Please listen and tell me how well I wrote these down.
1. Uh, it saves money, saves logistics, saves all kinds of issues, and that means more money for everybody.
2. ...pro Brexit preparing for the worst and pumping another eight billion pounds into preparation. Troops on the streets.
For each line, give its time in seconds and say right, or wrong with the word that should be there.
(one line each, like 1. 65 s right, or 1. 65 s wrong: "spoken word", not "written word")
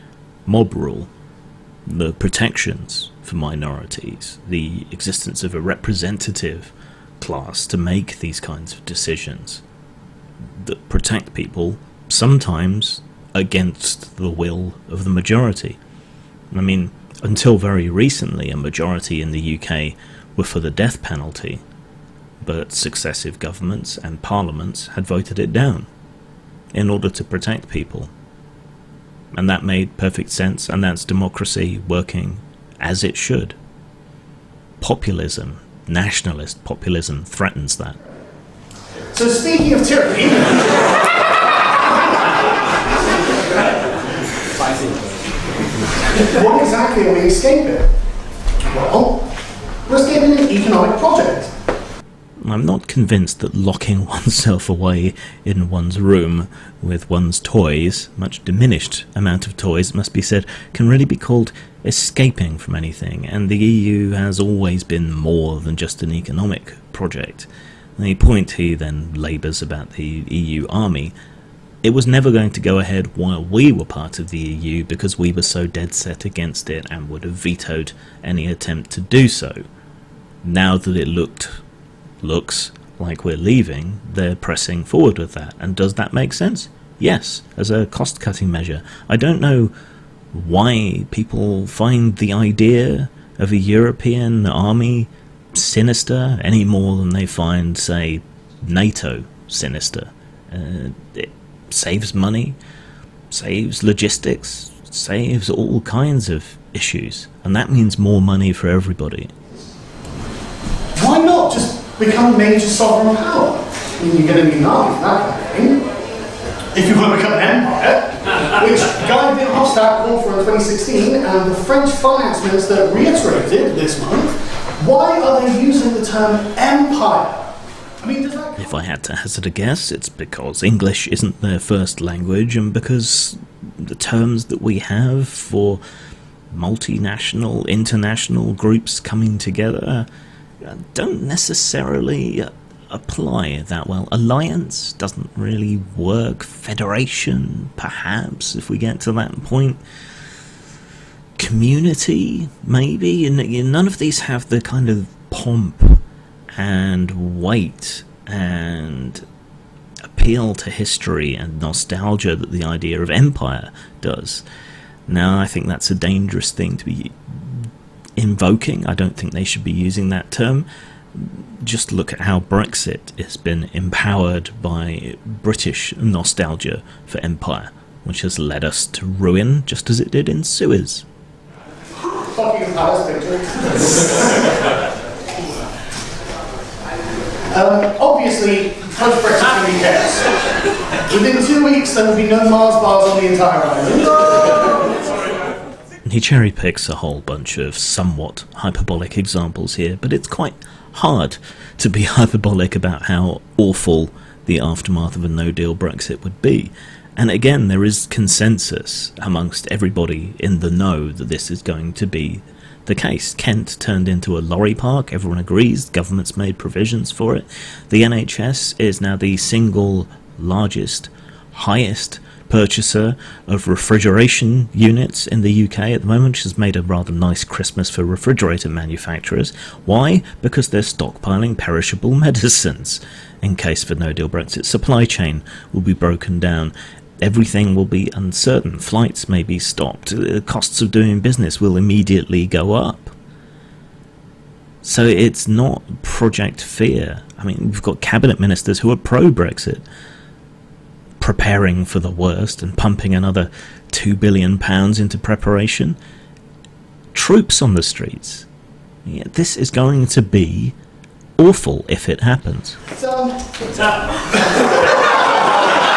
1. 100 s right
2. 248 s wrong: "two", not "eight".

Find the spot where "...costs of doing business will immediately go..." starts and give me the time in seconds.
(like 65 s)
240 s.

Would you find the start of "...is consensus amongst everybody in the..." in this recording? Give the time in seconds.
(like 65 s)
207 s.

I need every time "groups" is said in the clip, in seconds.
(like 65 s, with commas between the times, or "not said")
138 s.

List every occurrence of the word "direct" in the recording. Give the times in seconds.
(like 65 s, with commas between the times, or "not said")
not said.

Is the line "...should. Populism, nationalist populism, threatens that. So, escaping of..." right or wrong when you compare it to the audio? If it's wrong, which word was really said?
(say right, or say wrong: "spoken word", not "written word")
wrong: "speaking", not "escaping".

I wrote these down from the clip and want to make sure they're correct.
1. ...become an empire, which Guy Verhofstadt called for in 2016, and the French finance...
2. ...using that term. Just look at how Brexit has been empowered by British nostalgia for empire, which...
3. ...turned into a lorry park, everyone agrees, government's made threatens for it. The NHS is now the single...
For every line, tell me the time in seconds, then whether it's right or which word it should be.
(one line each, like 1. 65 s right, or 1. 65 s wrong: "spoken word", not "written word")
1. 117 s right
2. 169 s right
3. 213 s wrong: "provisions", not "threatens".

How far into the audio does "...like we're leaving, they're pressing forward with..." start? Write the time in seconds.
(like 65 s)
82 s.